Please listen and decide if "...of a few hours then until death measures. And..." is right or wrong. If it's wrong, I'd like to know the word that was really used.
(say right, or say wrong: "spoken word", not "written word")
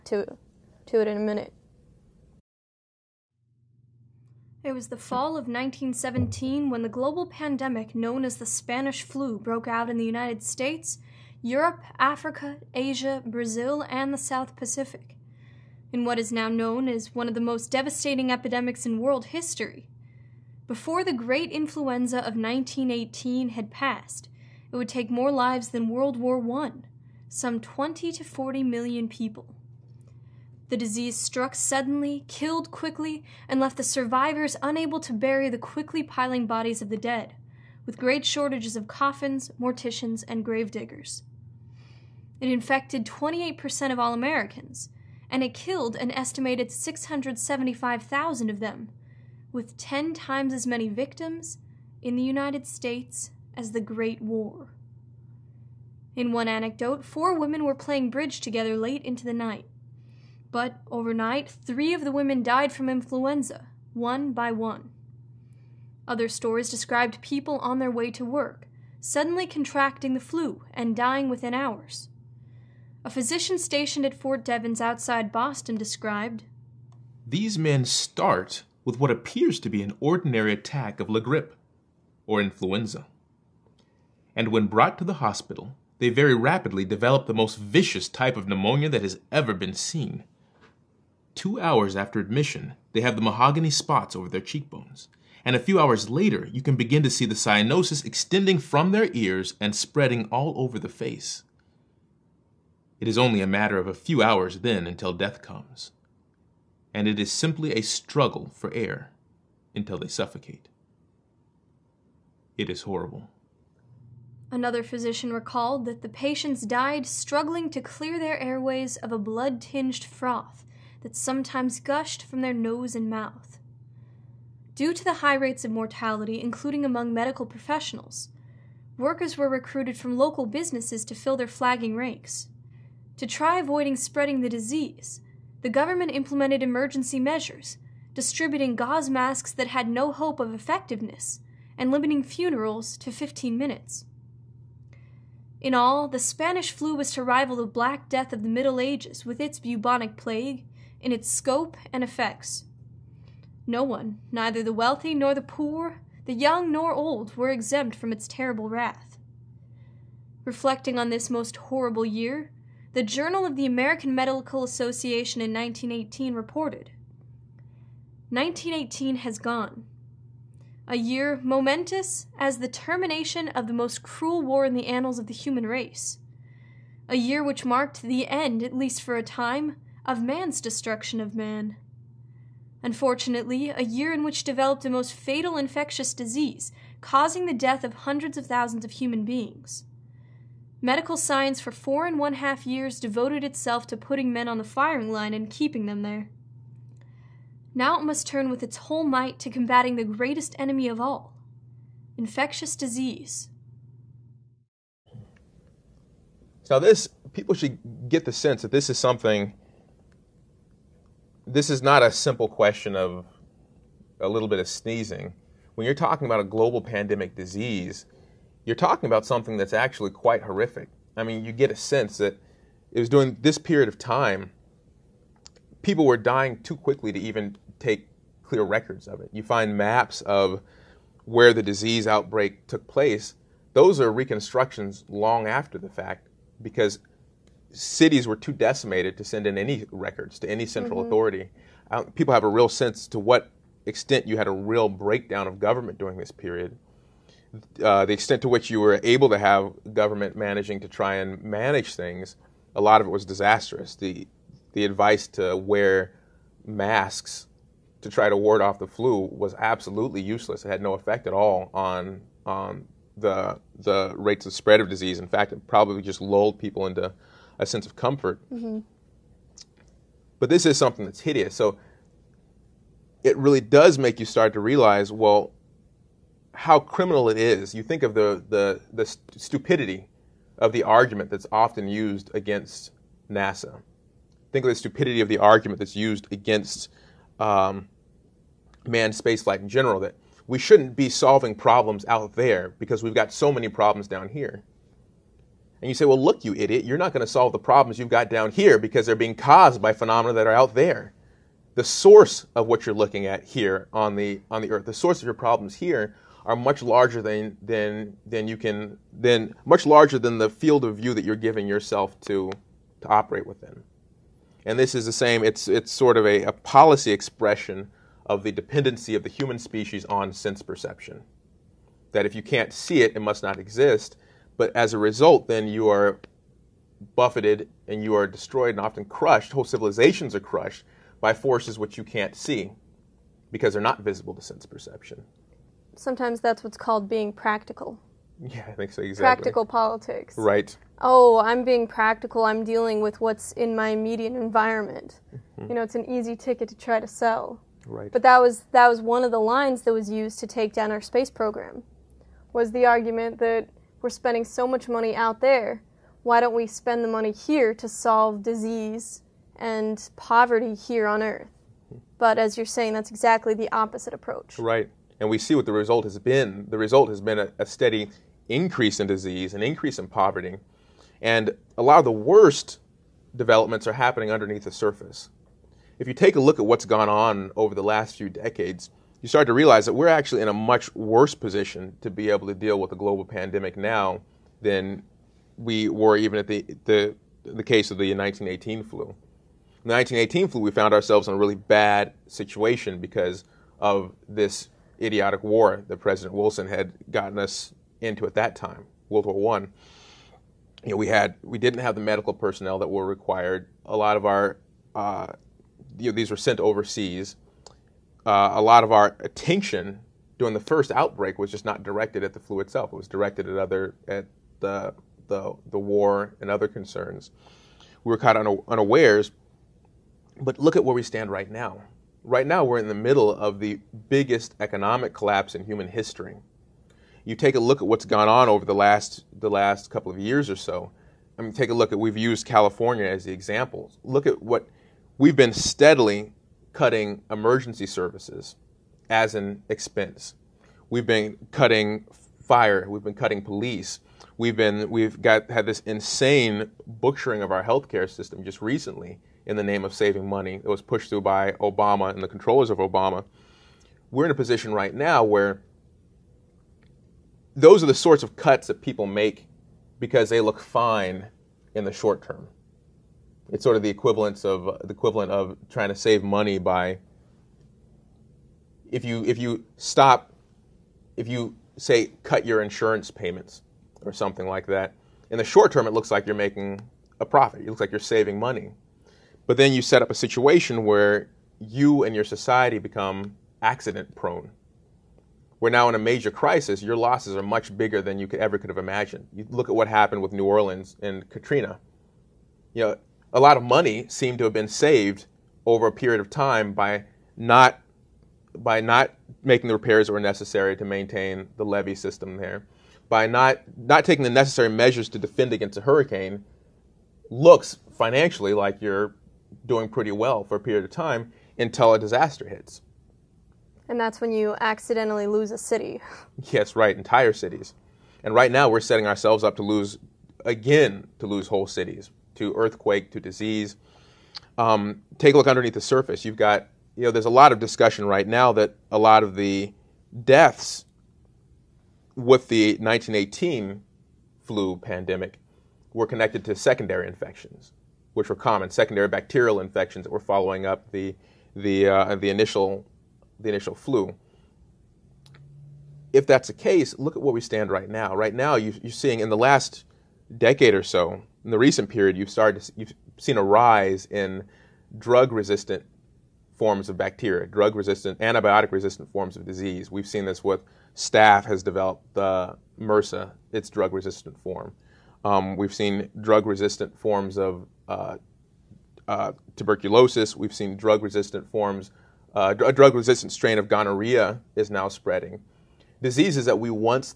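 wrong: "comes", not "measures".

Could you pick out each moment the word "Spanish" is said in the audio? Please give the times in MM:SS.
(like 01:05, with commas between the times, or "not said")
00:08, 02:26.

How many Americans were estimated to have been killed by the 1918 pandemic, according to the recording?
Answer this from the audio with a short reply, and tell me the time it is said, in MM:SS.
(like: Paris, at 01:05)
675,000, at 00:46.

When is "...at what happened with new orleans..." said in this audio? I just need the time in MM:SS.
08:09.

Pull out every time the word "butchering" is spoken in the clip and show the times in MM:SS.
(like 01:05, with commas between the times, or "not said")
07:26.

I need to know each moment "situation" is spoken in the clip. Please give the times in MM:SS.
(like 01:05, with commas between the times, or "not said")
06:32, 08:00.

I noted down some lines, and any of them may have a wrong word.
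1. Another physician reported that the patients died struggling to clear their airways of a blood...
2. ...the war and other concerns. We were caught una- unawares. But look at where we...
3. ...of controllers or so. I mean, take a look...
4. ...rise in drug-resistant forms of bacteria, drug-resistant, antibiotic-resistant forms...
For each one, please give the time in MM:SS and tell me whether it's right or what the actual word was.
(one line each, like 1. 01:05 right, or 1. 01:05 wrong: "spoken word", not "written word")
1. 01:54 wrong: "recalled", not "reported"
2. 06:55 right
3. 07:10 wrong: "years", not "controllers"
4. 09:13 right.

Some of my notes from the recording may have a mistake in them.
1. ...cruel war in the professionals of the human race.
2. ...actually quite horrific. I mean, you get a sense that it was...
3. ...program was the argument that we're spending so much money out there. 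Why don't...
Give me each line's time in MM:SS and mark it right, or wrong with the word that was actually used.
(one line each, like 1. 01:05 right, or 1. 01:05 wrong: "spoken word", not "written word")
1. 02:54 wrong: "annals", not "professionals"
2. 03:39 right
3. 05:51 right.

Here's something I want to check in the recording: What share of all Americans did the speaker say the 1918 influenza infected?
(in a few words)
28%.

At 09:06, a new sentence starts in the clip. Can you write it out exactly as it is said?
If that's the case, look at where we stand right now.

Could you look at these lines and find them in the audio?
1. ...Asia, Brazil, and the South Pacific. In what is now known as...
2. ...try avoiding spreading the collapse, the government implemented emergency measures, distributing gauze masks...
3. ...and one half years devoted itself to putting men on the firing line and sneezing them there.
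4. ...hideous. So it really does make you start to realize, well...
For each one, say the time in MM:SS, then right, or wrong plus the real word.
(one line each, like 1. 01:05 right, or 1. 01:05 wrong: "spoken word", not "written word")
1. 00:12 right
2. 02:13 wrong: "disease", not "collapse"
3. 03:12 wrong: "keeping", not "sneezing"
4. 04:31 right.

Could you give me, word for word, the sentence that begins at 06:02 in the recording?
But as you're saying, that's exactly the opposite approach.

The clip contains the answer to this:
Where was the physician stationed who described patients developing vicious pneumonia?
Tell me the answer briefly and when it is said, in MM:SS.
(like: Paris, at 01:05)
Fort Devens, at 01:14.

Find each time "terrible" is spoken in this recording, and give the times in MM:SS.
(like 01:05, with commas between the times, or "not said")
02:38.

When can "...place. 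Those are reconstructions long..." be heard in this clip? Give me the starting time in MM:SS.
03:52.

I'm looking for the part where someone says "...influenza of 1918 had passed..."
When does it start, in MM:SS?
00:21.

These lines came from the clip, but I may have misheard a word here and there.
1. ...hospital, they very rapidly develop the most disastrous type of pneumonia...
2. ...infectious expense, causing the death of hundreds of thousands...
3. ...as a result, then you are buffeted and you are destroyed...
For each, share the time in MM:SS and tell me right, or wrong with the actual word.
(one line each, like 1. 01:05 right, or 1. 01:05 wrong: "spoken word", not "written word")
1. 01:25 wrong: "vicious", not "disastrous"
2. 03:05 wrong: "disease", not "expense"
3. 05:24 right.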